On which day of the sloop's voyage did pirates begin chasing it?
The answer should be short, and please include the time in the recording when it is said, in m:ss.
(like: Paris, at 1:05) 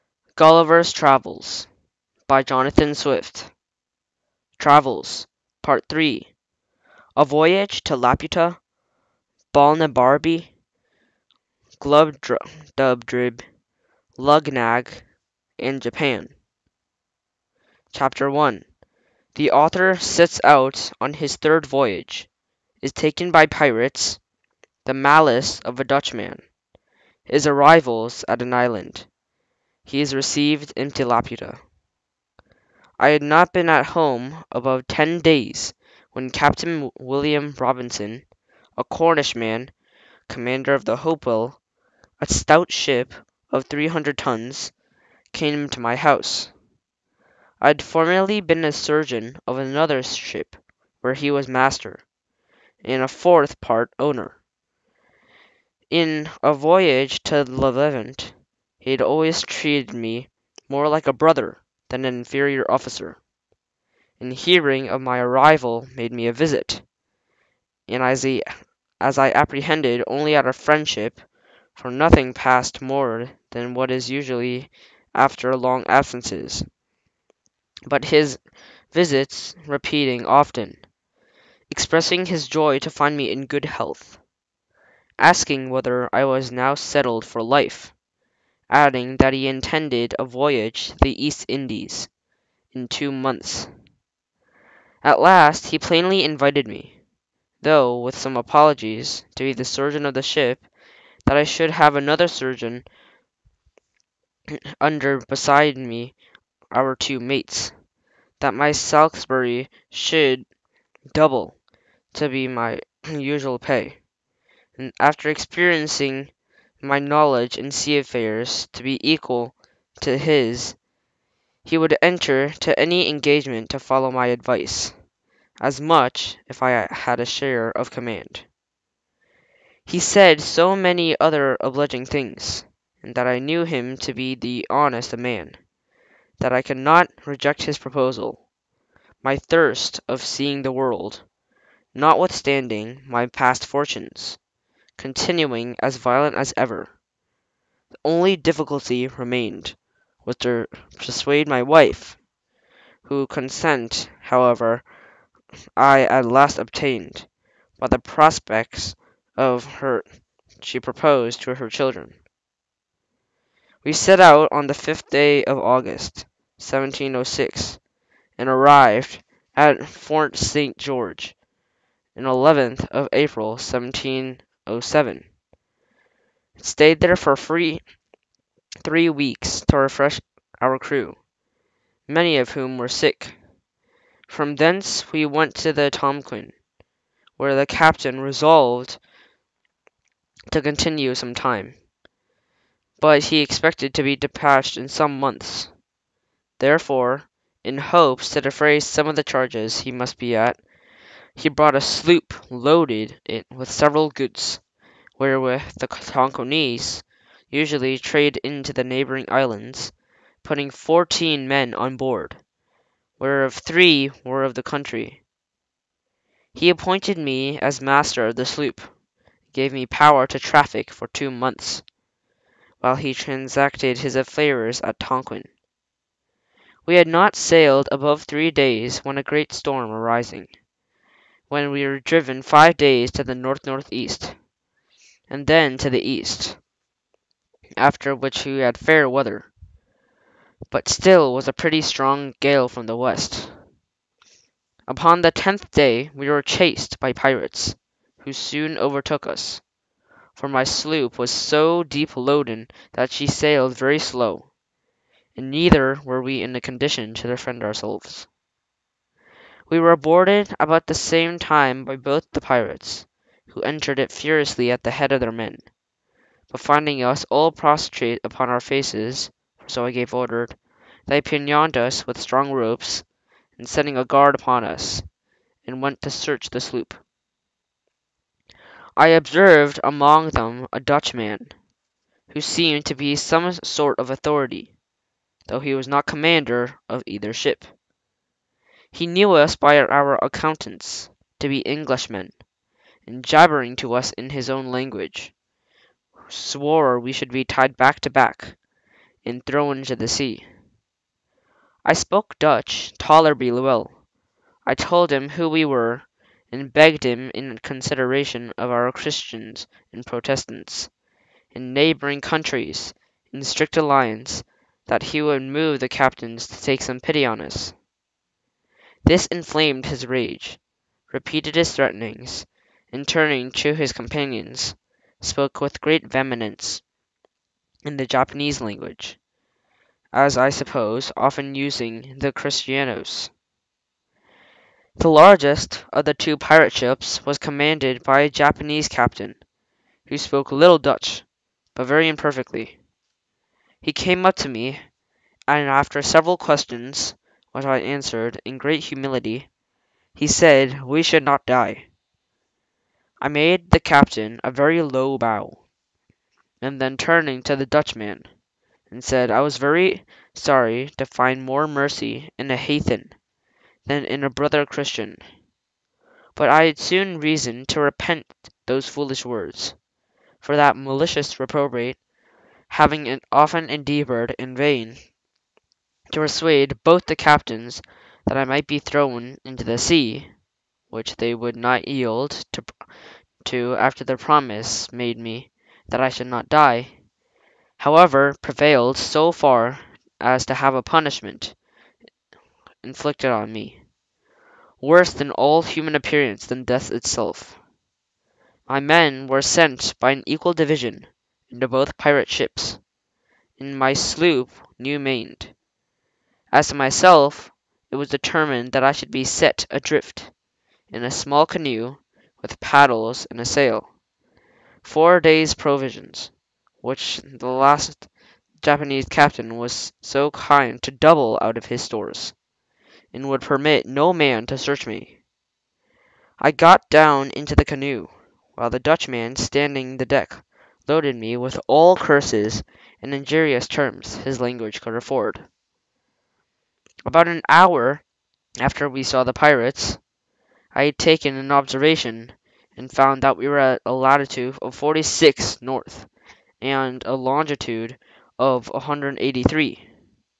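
The tenth day, at 4:05.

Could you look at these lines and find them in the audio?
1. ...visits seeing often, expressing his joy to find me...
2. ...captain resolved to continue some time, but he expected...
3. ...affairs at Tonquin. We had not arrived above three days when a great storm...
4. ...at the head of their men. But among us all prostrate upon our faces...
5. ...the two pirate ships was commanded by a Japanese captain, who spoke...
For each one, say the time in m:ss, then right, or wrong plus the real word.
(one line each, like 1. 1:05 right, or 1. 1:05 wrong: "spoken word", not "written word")
1. 1:18 wrong: "repeating", not "seeing"
2. 3:07 right
3. 3:44 wrong: "sailed", not "arrived"
4. 4:24 wrong: "finding", not "among"
5. 5:36 right.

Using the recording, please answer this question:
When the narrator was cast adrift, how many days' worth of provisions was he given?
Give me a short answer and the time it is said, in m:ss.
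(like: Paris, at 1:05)
4, at 6:54.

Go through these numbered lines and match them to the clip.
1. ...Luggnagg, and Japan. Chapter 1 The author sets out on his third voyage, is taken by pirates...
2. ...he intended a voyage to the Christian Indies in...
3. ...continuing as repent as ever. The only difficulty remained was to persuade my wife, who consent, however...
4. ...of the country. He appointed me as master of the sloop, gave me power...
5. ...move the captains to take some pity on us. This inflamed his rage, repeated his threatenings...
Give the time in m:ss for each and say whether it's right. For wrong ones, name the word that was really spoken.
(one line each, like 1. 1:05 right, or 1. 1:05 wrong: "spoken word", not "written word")
1. 0:14 right
2. 1:29 wrong: "East", not "Christian"
3. 2:24 wrong: "violent", not "repent"
4. 3:34 right
5. 5:15 right.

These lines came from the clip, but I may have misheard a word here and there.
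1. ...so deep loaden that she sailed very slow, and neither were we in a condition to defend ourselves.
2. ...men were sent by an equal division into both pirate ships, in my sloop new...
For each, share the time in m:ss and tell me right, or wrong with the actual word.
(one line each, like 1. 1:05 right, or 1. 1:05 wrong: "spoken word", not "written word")
1. 4:11 right
2. 6:38 right.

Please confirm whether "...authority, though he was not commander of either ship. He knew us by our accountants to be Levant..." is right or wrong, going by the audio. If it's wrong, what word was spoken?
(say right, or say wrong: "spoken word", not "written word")
wrong: "Englishmen", not "Levant".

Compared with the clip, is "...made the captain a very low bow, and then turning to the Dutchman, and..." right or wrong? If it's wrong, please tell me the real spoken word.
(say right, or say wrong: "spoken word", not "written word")
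right.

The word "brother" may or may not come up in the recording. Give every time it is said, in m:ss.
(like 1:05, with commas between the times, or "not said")
1:01, 6:04.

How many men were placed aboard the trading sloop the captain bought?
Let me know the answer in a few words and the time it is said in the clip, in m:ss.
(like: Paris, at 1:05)
14, at 3:30.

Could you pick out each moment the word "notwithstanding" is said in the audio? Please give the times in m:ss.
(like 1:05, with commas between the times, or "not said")
2:21.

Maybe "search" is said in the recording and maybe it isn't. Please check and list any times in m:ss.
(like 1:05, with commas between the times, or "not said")
4:36, 7:04.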